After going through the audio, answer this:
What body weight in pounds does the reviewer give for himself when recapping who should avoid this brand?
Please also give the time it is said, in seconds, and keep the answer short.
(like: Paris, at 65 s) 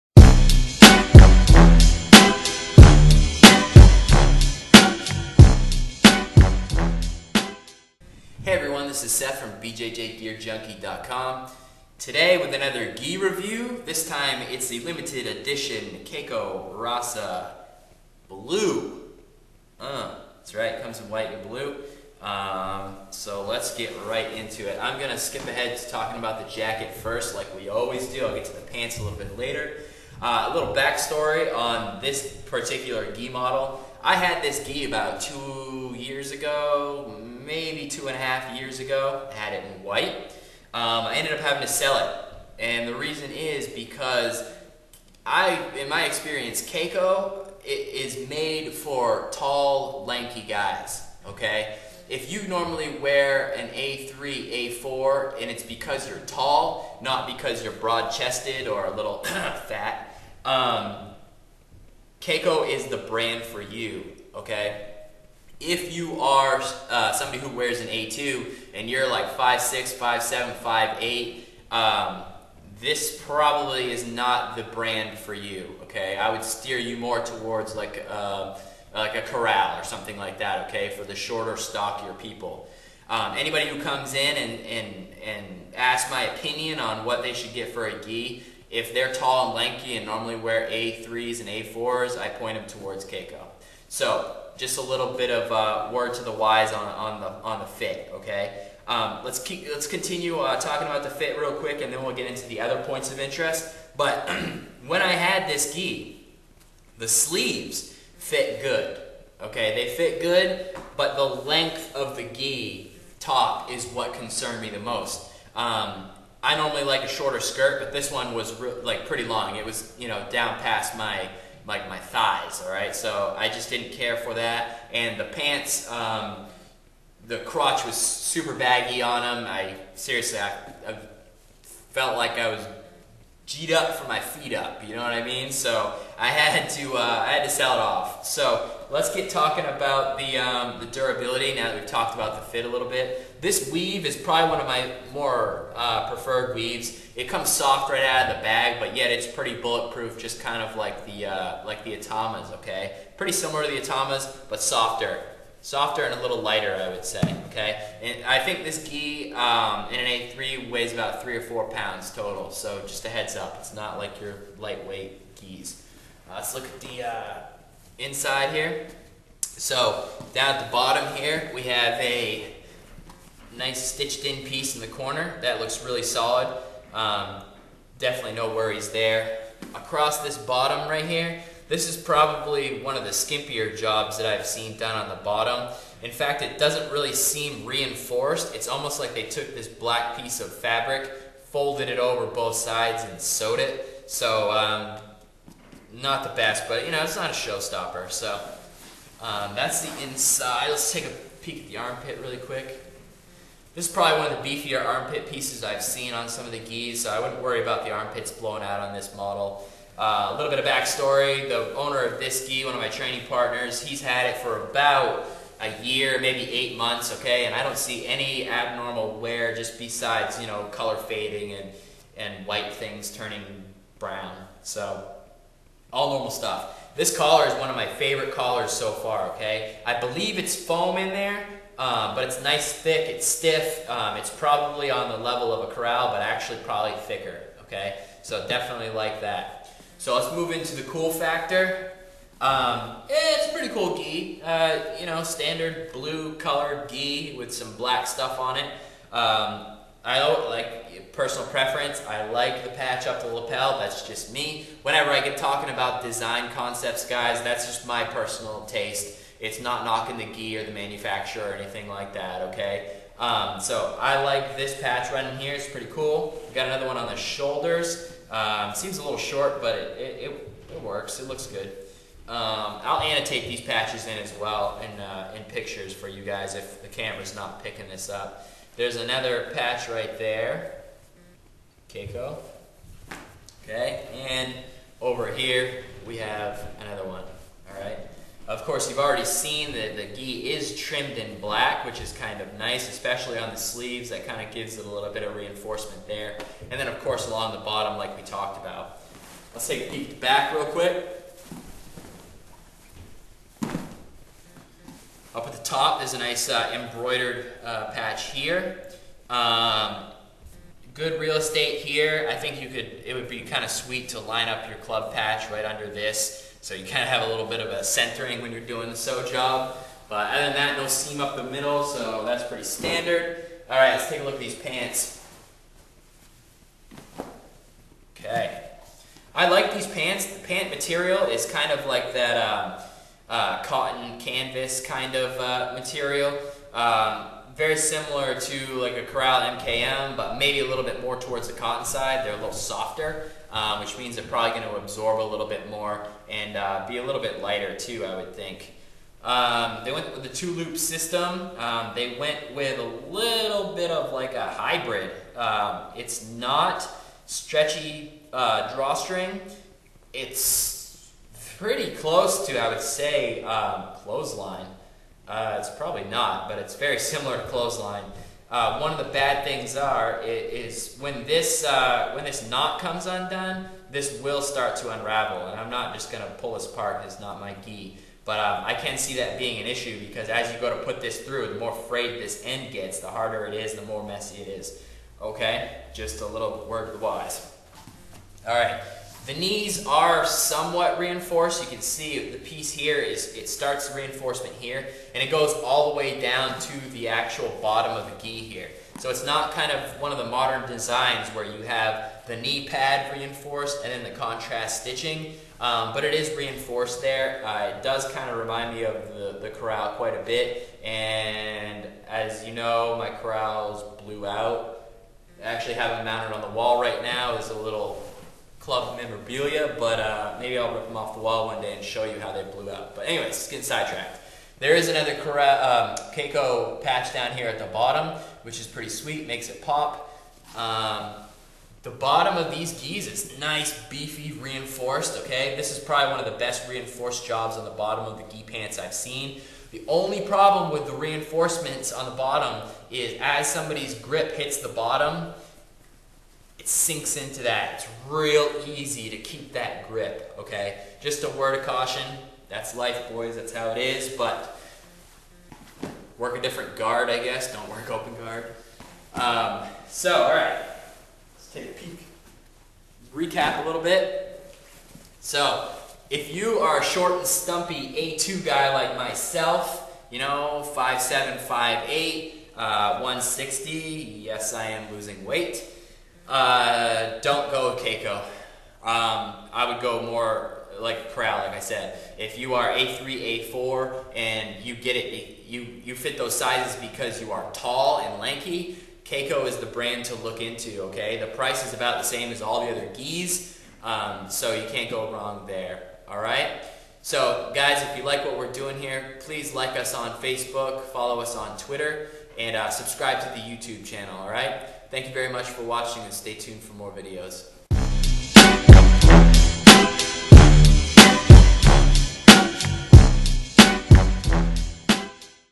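160, at 472 s.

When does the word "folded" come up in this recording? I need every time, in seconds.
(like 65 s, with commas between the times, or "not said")
191 s.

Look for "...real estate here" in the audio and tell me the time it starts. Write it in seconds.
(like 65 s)
311 s.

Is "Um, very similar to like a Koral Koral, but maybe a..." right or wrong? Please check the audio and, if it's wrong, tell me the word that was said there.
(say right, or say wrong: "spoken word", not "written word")
wrong: "MKM", not "Koral".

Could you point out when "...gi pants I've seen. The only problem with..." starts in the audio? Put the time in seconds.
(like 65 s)
438 s.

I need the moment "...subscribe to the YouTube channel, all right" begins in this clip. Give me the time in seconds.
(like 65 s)
502 s.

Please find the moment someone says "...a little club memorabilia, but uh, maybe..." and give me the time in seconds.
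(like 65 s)
417 s.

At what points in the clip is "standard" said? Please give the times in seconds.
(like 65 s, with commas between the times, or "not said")
245 s, 322 s.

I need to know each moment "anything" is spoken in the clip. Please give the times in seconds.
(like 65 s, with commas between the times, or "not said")
261 s.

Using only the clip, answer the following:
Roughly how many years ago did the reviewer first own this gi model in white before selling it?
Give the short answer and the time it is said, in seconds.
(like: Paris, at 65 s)
2 years, at 35 s.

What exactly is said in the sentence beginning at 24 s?
I'm going to skip ahead to talking about the jacket first, like we always do.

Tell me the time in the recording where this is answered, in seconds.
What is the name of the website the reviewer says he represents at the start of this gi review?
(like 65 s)
9 s.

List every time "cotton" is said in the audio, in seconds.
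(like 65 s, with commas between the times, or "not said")
333 s, 341 s.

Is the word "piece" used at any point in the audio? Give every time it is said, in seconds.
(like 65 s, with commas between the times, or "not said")
174 s, 190 s, 205 s, 392 s.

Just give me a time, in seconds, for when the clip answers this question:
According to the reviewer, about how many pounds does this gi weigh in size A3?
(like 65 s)
161 s.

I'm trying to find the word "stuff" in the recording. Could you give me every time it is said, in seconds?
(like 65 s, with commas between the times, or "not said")
226 s, 248 s.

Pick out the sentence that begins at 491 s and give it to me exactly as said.
The price is about the same as all the other geese, um, so you can't go wrong there, all right?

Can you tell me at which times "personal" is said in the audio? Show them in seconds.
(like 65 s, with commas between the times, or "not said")
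251 s, 258 s.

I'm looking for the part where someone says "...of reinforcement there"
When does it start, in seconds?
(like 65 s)
295 s.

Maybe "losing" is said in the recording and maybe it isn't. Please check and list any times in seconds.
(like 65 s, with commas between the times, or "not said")
474 s.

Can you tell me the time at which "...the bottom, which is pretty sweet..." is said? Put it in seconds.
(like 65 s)
427 s.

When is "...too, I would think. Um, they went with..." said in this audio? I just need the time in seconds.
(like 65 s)
347 s.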